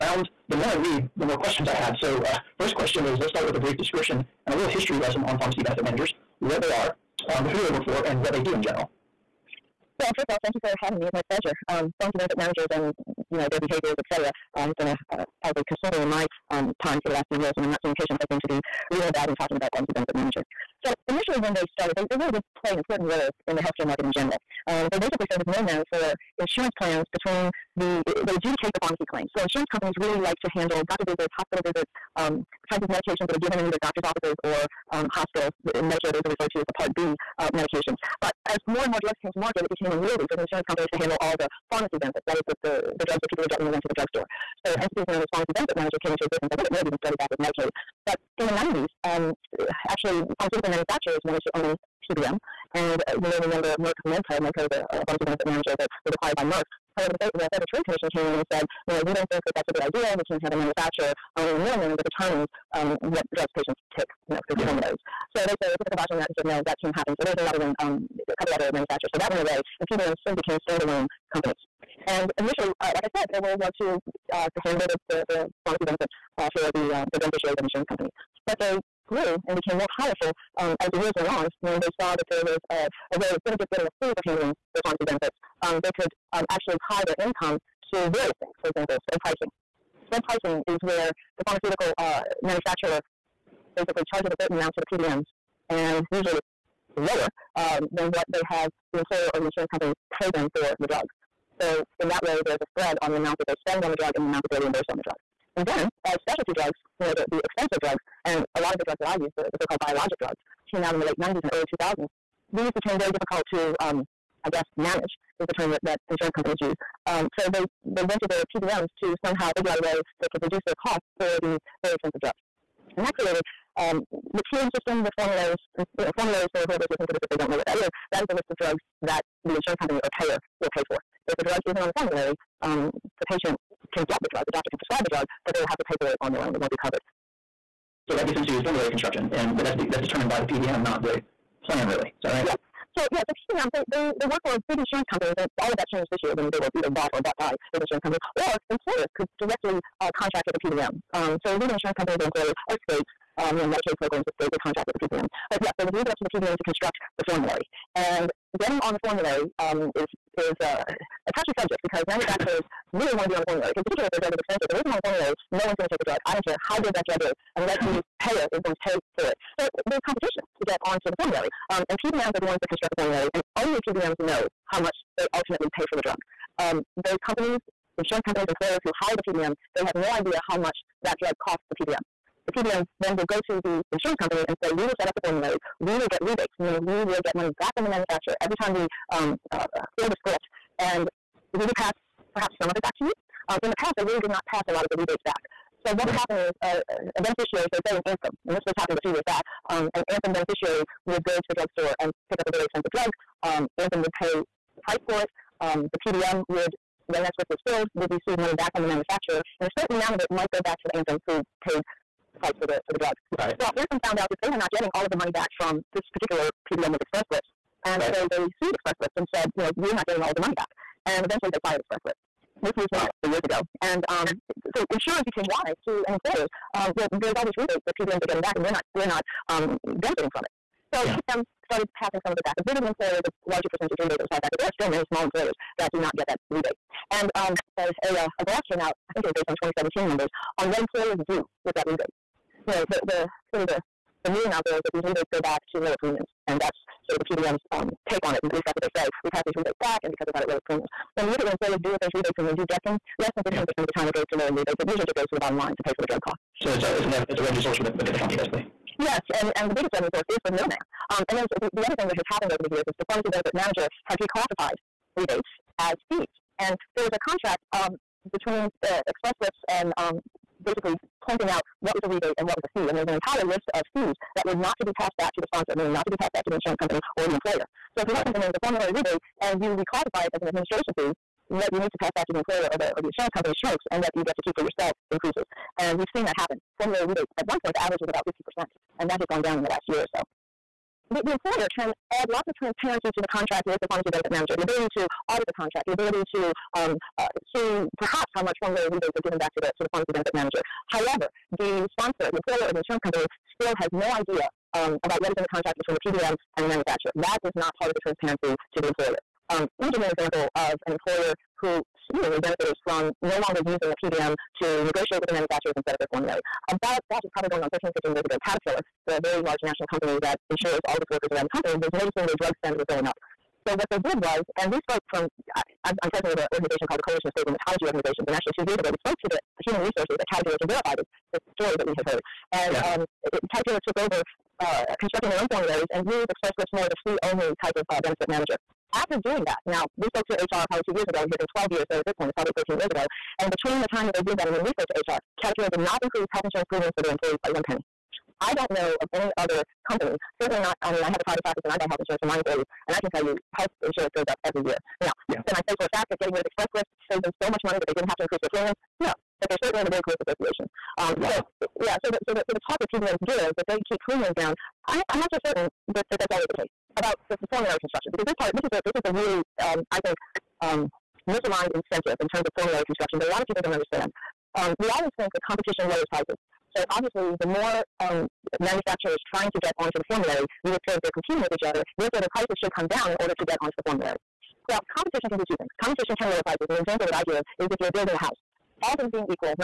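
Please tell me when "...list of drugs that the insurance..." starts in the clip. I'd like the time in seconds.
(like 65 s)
128 s.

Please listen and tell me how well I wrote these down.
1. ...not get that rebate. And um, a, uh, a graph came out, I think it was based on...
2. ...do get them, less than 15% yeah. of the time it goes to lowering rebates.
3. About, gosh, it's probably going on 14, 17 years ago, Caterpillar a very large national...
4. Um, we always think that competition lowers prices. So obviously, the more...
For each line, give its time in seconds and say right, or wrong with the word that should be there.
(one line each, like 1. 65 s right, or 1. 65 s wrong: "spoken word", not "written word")
1. 235 s right
2. 252 s right
3. 316 s wrong: "15", not "17"
4. 374 s right.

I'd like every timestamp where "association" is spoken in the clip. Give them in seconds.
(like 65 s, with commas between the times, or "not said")
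360 s.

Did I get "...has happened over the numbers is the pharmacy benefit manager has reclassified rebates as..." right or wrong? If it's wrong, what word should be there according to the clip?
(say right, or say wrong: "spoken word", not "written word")
wrong: "years", not "numbers".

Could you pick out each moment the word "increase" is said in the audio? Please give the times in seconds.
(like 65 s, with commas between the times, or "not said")
285 s, 346 s, 358 s.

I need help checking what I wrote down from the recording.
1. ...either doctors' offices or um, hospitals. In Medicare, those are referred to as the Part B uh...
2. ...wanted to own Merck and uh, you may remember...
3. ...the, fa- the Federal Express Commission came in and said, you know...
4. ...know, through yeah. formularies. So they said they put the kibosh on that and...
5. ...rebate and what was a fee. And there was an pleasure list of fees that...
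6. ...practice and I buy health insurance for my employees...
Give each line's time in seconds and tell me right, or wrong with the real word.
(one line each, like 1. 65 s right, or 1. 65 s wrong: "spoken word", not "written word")
1. 33 s right
2. 51 s wrong: "PBM", not "Merck"
3. 57 s wrong: "Trade", not "Express"
4. 64 s right
5. 272 s wrong: "entire", not "pleasure"
6. 351 s right.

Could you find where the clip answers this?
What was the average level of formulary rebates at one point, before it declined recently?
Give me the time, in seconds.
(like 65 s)
288 s.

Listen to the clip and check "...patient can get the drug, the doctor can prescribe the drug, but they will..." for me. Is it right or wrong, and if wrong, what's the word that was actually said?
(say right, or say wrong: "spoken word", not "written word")
right.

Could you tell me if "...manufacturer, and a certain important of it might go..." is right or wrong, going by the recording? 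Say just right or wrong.
wrong.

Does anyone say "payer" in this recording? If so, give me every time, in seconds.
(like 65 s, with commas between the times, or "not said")
130 s, 168 s.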